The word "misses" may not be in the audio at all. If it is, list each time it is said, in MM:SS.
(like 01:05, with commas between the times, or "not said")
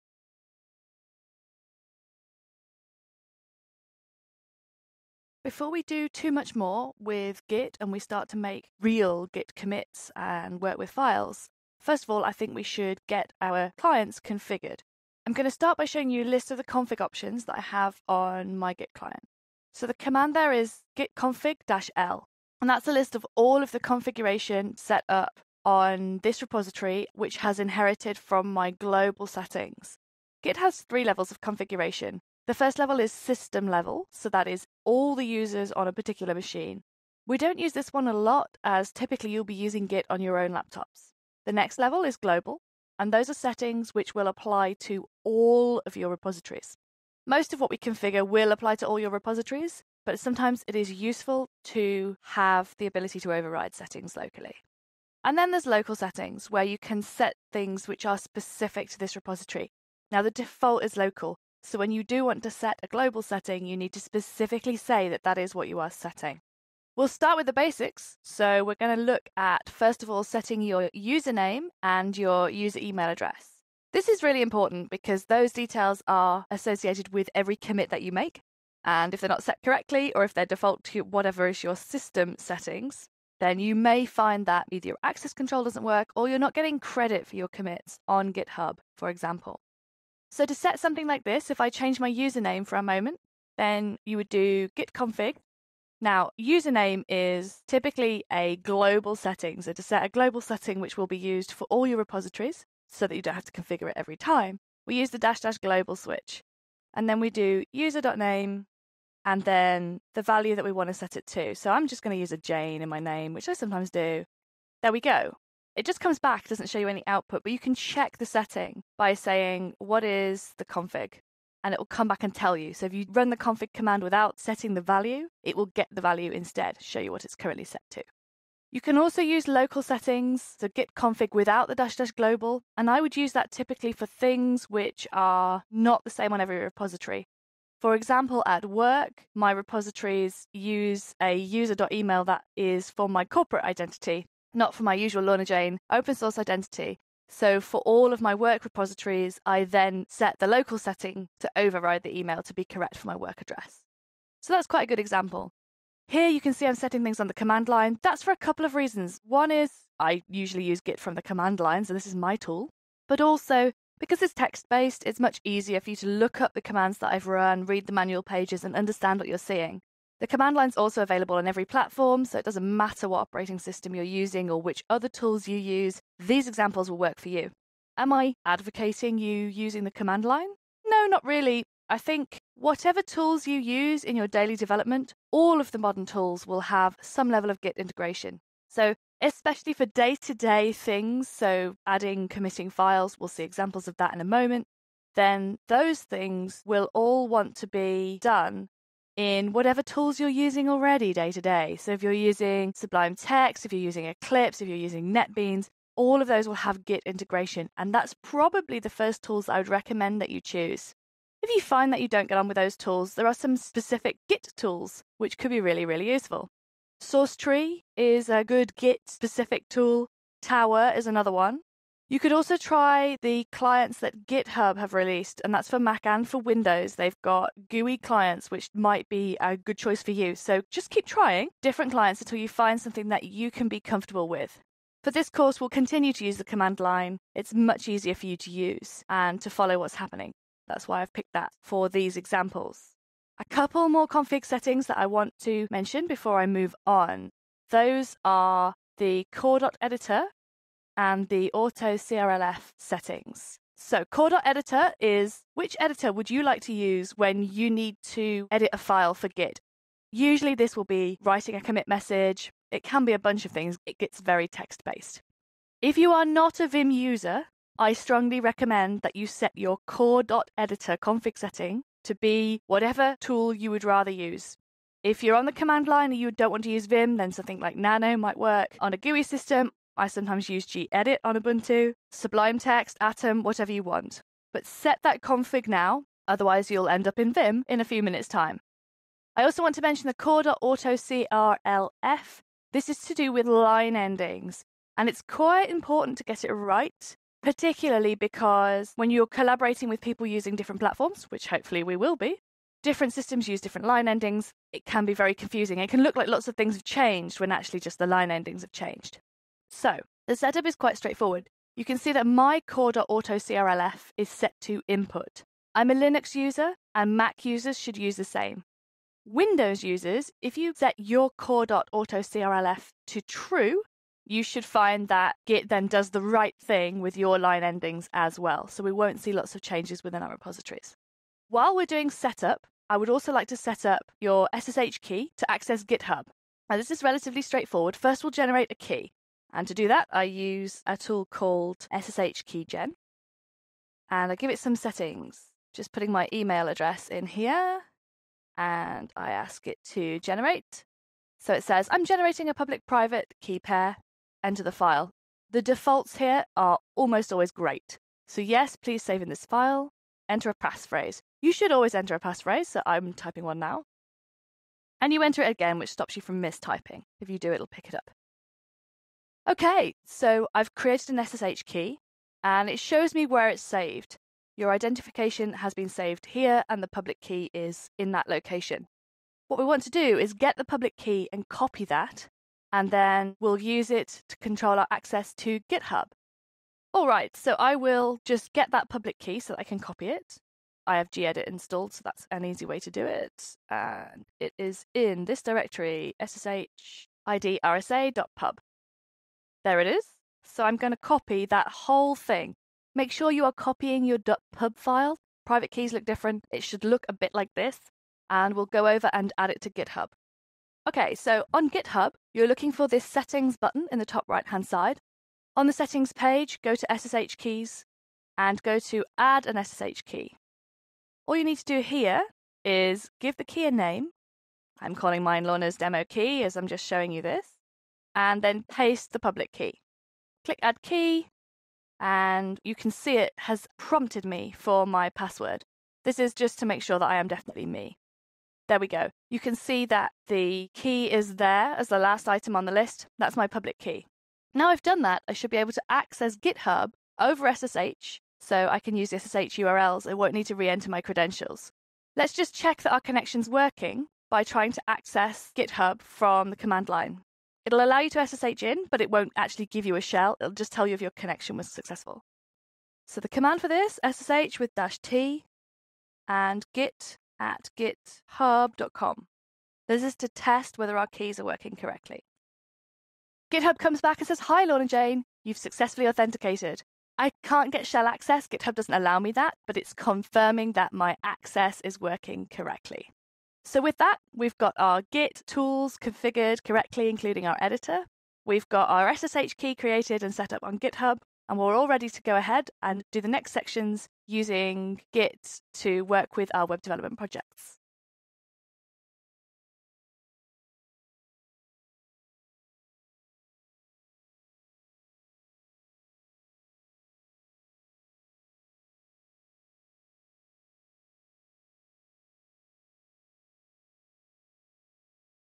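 not said.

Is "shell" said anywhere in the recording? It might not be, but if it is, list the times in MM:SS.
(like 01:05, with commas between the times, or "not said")
07:40, 07:57.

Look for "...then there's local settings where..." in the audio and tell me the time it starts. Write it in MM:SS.
00:55.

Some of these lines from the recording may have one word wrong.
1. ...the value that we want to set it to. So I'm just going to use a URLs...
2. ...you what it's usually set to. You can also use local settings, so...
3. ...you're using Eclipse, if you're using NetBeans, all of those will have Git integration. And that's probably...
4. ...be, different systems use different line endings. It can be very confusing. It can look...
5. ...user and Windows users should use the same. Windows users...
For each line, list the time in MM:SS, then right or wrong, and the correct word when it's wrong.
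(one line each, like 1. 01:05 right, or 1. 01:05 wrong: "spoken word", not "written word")
1. 01:50 wrong: "Jane", not "URLs"
2. 02:06 wrong: "currently", not "usually"
3. 03:23 right
4. 05:02 right
5. 05:16 wrong: "Mac", not "Windows".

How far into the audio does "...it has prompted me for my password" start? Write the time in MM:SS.
07:13.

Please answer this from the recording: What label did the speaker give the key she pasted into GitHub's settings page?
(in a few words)
Lorna's demo key.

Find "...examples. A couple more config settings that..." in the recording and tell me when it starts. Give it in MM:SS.
04:02.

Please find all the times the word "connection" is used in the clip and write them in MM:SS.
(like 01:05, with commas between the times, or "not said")
07:32, 07:41.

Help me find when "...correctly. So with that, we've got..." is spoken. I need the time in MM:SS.
08:02.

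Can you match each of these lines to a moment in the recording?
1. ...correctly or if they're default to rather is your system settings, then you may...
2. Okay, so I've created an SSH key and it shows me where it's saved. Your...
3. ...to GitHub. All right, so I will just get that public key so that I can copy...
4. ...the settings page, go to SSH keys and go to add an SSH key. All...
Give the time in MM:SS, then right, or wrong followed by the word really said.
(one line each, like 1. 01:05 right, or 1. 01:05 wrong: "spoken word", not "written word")
1. 01:19 wrong: "whatever", not "rather"
2. 06:09 right
3. 06:25 right
4. 06:55 right.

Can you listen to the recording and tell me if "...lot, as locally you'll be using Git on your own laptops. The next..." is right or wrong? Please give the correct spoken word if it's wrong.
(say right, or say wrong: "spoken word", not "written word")
wrong: "typically", not "locally".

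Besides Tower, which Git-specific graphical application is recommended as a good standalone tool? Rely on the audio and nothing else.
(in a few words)
SourceTree.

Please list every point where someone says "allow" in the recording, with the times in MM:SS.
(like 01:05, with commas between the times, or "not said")
07:37, 07:58.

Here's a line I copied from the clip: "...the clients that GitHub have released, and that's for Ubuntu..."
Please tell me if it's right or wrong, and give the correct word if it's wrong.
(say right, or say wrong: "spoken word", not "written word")
wrong: "Mac", not "Ubuntu".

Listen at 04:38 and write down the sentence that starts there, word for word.
On a GUI system, I sometimes use gedit on Ubuntu, Sublime Text, Atom, whatever you want.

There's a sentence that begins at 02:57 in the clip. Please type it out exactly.
Am I advocating you using the command line?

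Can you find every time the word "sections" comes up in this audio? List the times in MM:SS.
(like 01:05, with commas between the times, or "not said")
08:13.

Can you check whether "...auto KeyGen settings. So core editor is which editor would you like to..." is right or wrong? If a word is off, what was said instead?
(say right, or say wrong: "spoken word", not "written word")
wrong: "CRLF", not "KeyGen".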